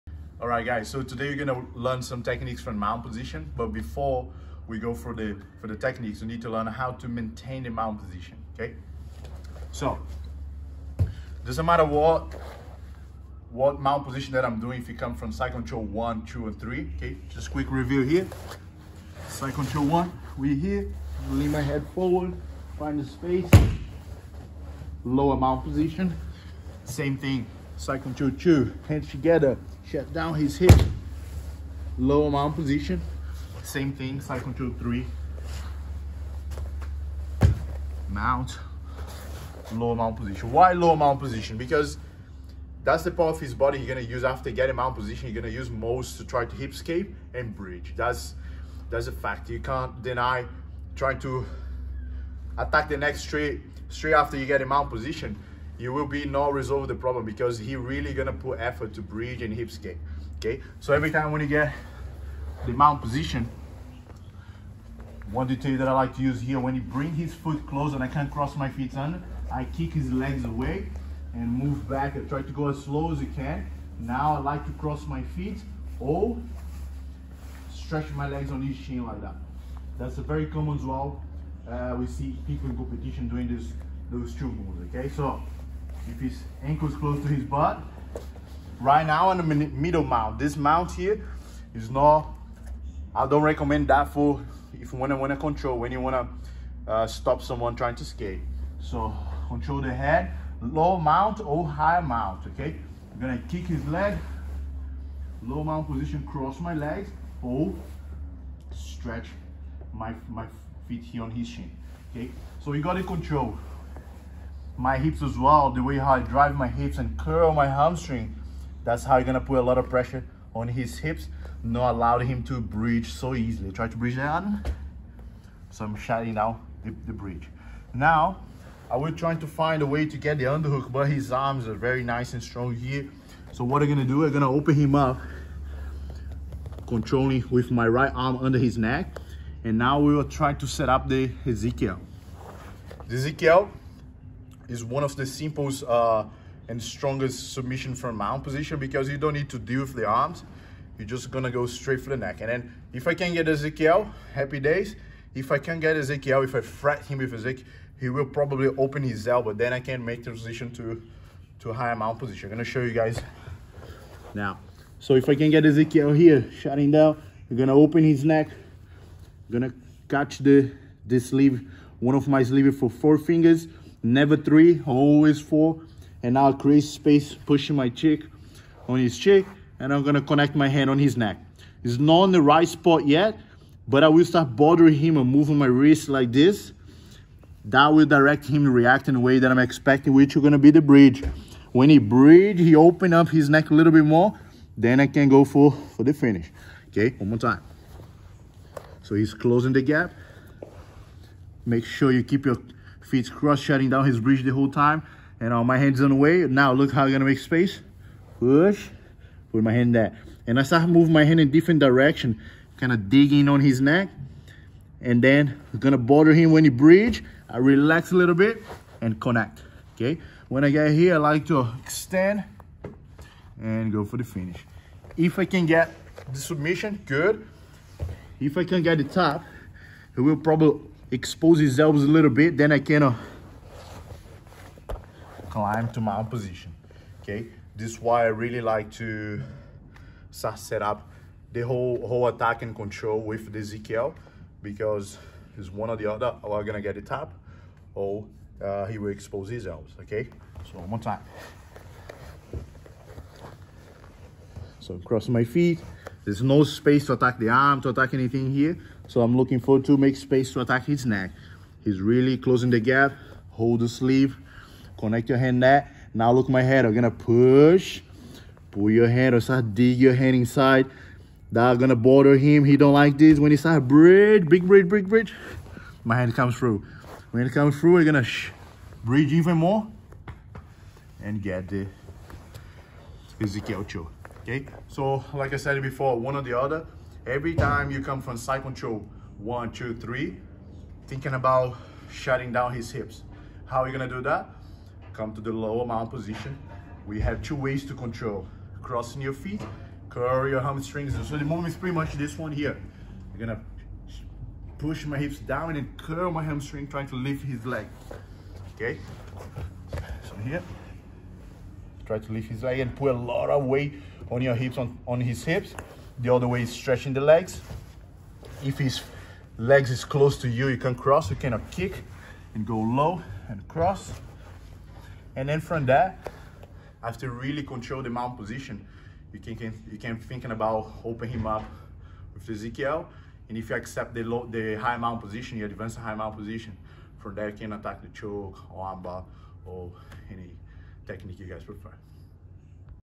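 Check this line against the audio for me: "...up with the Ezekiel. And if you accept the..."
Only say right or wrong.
right.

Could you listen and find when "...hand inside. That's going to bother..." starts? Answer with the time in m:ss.
4:30.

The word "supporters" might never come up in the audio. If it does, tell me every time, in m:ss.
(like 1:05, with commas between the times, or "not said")
not said.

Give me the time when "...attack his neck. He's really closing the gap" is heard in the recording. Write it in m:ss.
4:20.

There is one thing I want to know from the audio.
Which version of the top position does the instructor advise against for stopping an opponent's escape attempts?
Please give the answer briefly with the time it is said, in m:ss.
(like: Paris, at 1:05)
Middle mount, at 1:29.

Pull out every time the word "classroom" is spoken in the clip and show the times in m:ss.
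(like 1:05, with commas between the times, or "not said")
not said.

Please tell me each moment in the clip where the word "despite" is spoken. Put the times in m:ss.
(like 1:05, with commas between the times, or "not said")
not said.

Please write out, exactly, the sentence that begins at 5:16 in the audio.
The other way is stretching the legs.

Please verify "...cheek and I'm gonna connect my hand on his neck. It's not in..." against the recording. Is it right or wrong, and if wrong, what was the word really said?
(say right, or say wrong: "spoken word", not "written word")
right.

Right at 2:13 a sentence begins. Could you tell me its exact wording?
So what I'm gonna do, I'm gonna open him up, controlling with my right arm under his neck.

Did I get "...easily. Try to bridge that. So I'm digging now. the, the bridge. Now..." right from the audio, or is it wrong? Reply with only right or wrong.
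wrong.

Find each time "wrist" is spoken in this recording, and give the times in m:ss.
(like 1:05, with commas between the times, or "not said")
3:05.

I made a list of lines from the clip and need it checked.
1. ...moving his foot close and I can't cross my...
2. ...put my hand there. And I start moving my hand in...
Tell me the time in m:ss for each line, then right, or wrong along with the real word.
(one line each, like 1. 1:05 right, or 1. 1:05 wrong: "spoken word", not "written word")
1. 1:06 wrong: "bring", not "moving"
2. 3:29 right.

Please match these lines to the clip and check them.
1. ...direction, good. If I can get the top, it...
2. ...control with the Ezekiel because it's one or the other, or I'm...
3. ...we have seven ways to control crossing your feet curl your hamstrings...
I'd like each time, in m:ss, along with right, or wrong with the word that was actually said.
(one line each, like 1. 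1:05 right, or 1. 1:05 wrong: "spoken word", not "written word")
1. 3:46 wrong: "submission", not "direction"
2. 4:02 right
3. 4:57 wrong: "two", not "seven".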